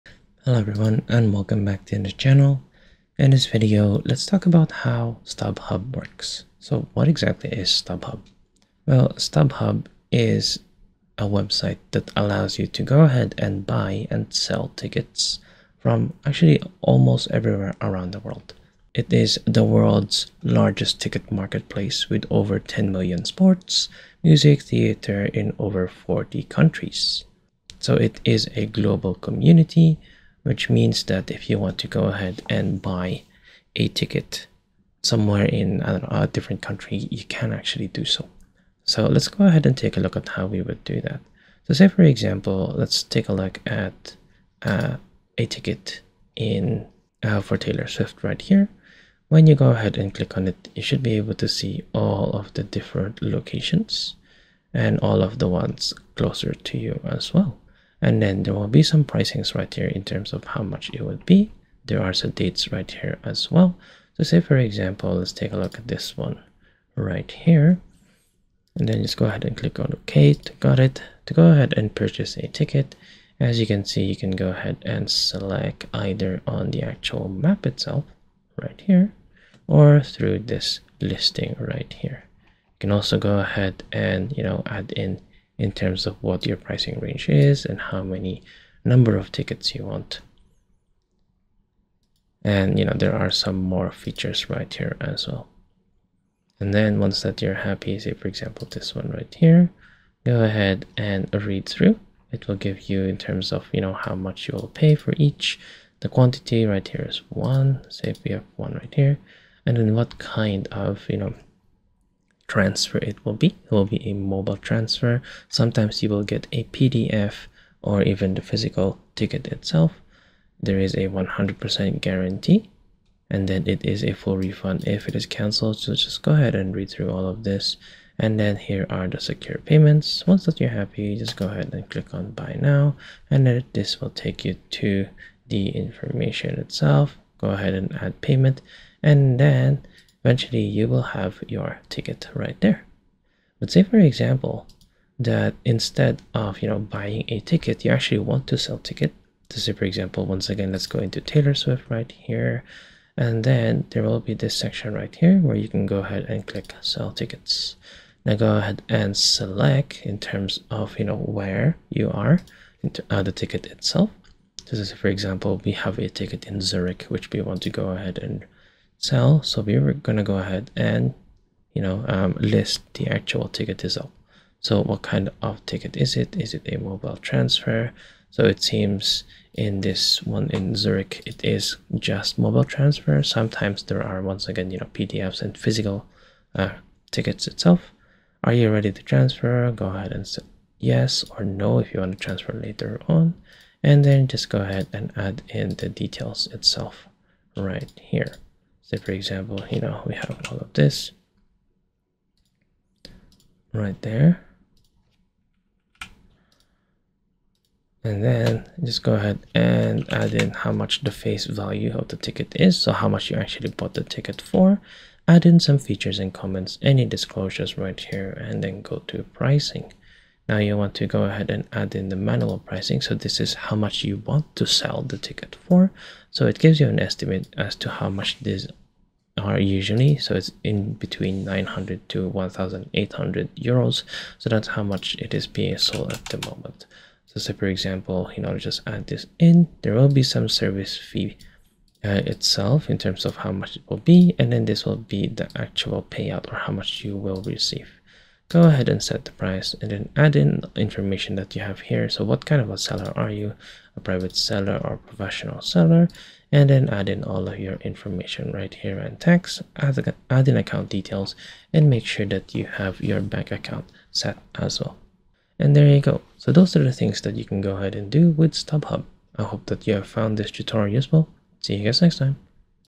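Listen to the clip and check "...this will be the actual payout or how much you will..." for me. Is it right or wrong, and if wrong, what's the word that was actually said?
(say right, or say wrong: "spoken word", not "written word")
right.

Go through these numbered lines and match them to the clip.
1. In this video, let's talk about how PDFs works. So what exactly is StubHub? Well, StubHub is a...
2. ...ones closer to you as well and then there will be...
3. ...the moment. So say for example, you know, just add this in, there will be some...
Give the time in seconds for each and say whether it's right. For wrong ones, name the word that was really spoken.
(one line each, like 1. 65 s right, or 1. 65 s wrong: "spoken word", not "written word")
1. 3 s wrong: "StubHub", not "PDFs"
2. 55 s right
3. 236 s right.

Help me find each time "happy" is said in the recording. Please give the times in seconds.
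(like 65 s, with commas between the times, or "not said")
97 s, 130 s.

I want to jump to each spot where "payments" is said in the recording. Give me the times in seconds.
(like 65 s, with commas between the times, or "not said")
129 s, 138 s.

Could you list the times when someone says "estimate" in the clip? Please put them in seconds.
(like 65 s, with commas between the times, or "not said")
226 s.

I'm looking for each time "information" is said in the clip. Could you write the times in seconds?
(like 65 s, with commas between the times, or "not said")
135 s, 250 s, 257 s.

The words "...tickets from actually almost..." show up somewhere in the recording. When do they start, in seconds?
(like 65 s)
14 s.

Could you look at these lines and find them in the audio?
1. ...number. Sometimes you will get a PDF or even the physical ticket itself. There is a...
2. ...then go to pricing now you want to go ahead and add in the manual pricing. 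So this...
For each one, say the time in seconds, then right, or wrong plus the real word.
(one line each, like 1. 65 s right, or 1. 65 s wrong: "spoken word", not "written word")
1. 114 s wrong: "transfer", not "number"
2. 218 s right.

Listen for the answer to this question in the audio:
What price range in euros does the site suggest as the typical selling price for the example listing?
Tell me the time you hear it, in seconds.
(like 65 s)
231 s.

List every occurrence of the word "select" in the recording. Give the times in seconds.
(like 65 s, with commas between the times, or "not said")
75 s, 159 s.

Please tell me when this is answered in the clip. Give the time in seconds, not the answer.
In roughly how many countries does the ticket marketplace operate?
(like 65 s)
25 s.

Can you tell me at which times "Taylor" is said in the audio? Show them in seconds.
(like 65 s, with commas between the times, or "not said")
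47 s, 151 s.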